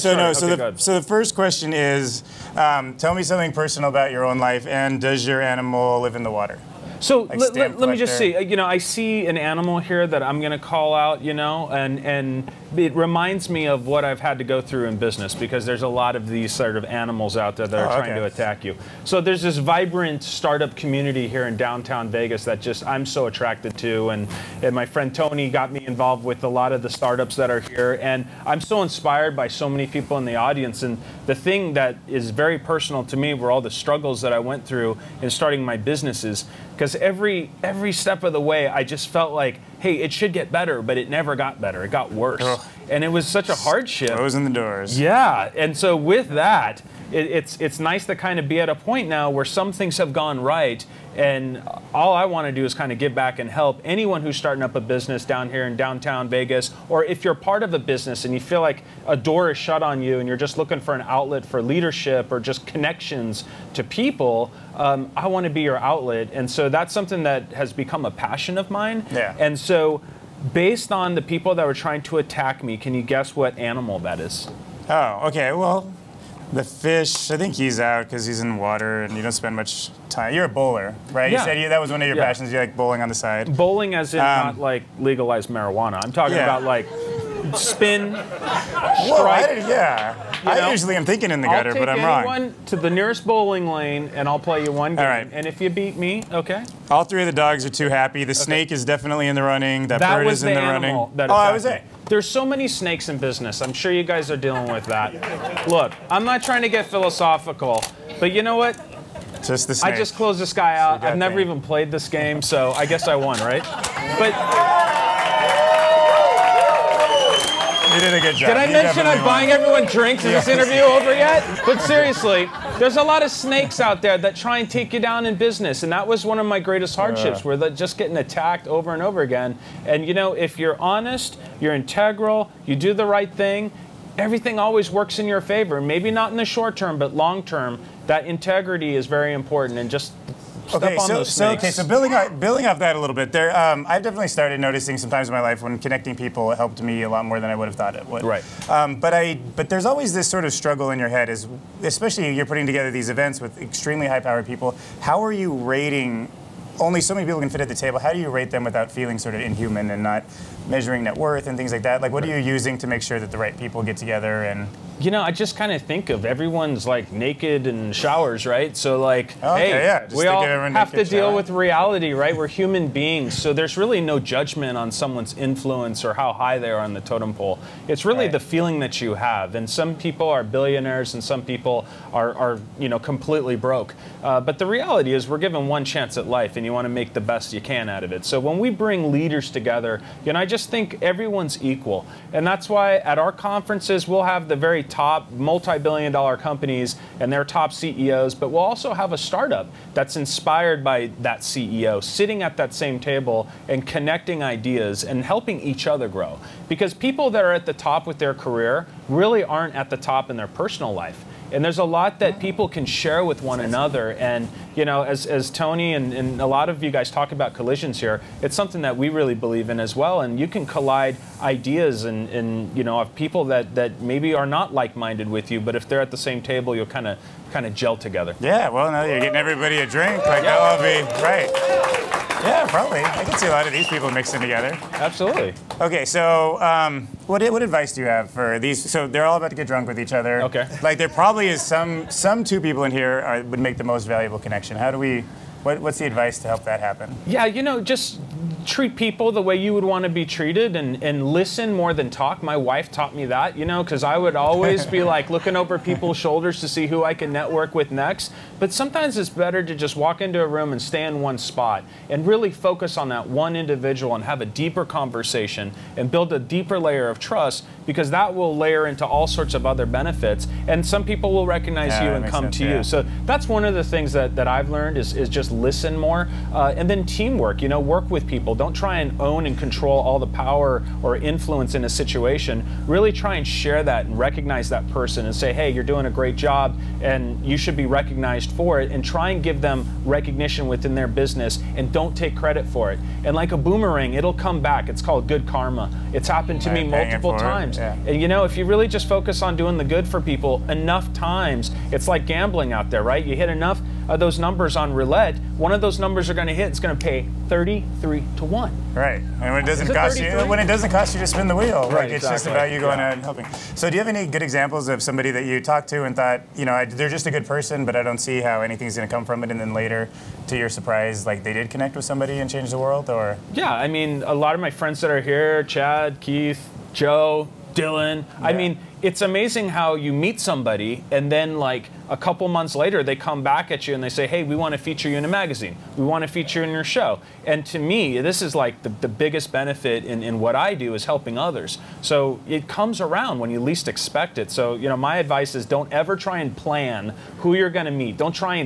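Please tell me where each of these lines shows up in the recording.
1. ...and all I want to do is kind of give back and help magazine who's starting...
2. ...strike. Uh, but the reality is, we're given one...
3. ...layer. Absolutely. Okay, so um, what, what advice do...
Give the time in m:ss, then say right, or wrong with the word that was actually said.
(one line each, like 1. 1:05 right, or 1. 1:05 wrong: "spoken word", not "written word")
1. 0:51 wrong: "anyone", not "magazine"
2. 3:03 wrong: "broke", not "strike"
3. 3:54 wrong: "together", not "layer".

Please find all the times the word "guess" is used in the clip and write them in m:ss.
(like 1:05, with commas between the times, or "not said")
1:13, 1:52.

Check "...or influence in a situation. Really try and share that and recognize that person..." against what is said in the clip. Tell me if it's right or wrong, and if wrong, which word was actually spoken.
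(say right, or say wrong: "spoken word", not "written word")
right.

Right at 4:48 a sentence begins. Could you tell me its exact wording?
And try and give them recognition within their business and don't take credit for it.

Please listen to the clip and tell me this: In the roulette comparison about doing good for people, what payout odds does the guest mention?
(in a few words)
33 to 1.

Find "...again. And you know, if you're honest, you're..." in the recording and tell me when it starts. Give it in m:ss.
2:09.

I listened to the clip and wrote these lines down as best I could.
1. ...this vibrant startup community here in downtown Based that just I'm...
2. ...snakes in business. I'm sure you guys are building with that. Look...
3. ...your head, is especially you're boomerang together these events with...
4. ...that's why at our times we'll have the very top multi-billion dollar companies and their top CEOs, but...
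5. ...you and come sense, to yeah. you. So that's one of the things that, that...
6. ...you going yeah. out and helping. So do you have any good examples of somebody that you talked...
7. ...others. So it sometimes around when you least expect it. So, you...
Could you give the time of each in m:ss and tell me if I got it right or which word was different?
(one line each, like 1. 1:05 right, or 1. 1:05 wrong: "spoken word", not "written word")
1. 0:19 wrong: "Vegas", not "Based"
2. 1:42 wrong: "dealing", not "building"
3. 2:30 wrong: "putting", not "boomerang"
4. 3:12 wrong: "conferences", not "times"
5. 4:32 right
6. 5:12 right
7. 5:41 wrong: "comes", not "sometimes".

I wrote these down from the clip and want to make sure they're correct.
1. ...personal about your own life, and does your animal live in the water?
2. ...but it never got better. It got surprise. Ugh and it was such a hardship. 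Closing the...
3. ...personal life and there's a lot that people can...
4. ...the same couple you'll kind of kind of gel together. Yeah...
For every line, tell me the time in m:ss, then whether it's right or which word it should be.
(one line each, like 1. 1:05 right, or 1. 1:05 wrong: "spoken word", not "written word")
1. 0:03 right
2. 0:40 wrong: "worse", not "surprise"
3. 3:30 right
4. 3:46 wrong: "table", not "couple".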